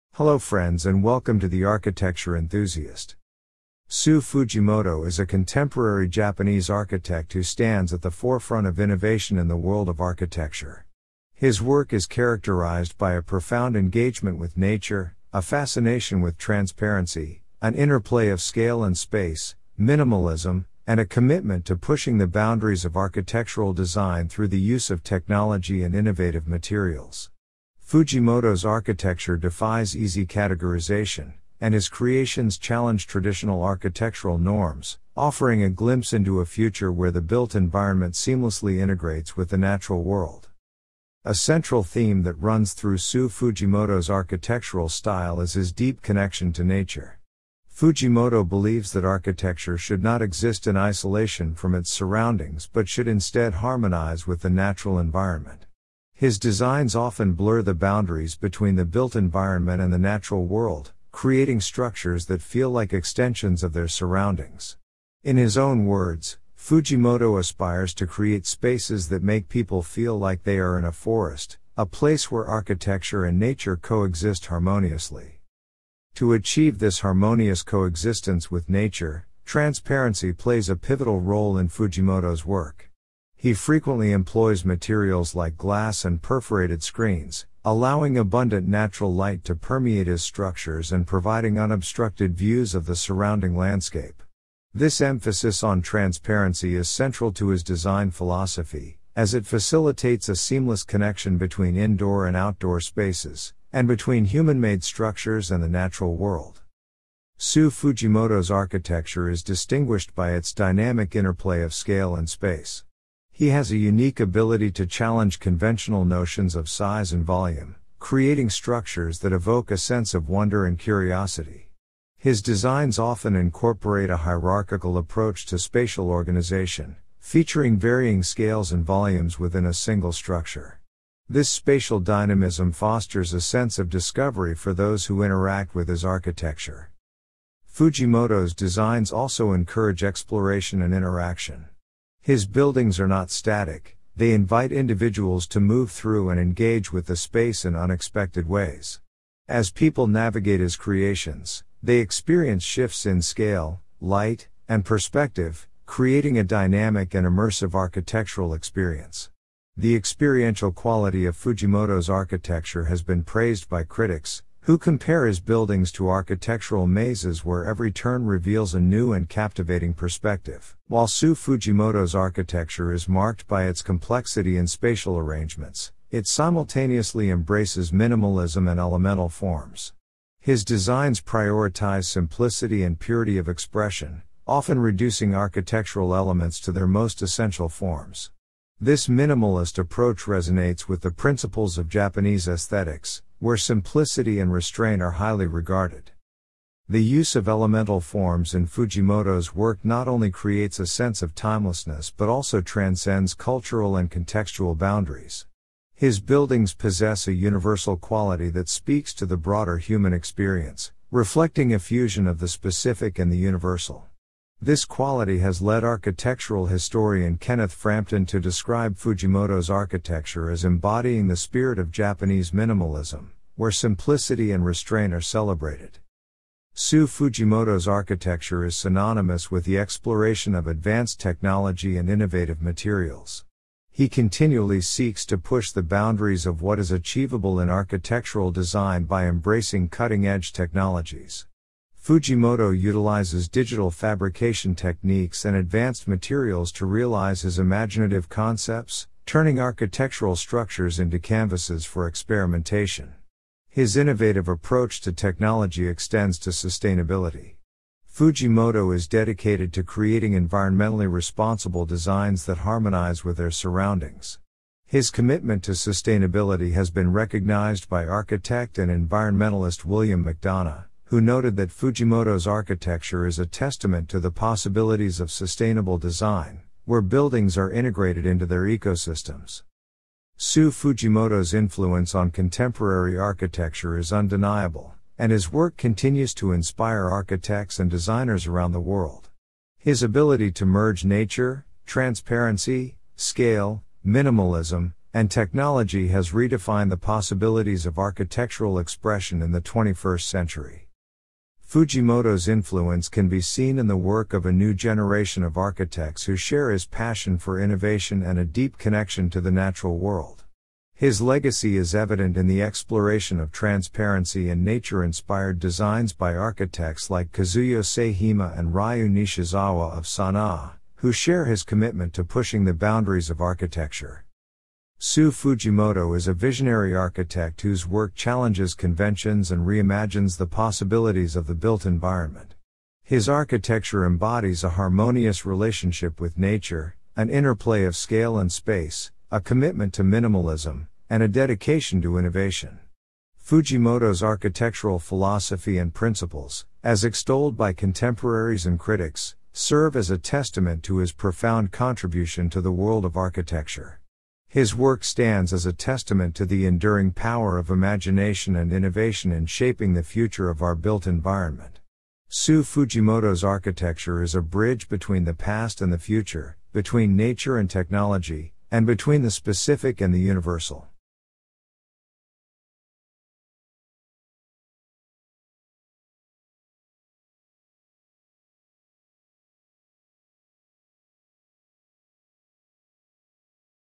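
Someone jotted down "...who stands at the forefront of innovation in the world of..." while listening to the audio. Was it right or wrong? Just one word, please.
right.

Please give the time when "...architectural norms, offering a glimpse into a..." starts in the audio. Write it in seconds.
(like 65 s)
33 s.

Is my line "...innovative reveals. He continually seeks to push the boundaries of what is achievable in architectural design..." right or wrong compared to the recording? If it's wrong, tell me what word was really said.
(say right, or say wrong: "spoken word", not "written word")
wrong: "materials", not "reveals".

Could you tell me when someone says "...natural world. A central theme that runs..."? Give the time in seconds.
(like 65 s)
39 s.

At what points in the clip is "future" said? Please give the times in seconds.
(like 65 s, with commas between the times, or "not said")
36 s, 360 s, 365 s.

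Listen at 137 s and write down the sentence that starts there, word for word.
Fujimoto's designs also encourage exploration and interaction.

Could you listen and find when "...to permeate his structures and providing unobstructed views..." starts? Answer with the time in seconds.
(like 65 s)
89 s.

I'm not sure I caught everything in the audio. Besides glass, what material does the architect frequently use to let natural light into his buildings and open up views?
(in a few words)
Perforated screens.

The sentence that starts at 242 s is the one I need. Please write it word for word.
Fujimoto utilizes digital fabrication techniques and advanced materials to realize his imaginative concepts, turning architectural structures into canvases for experimentation.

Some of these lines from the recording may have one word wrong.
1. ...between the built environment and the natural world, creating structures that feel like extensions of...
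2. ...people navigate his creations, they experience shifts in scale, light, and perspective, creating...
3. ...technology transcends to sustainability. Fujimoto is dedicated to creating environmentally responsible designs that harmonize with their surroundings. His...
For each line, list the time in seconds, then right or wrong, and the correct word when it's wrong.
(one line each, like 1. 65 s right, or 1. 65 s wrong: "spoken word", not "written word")
1. 58 s right
2. 149 s right
3. 255 s wrong: "extends", not "transcends".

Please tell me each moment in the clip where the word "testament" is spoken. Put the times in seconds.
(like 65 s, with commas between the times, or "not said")
273 s, 350 s, 355 s.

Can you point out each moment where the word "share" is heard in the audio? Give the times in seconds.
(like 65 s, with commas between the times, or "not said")
306 s, 321 s.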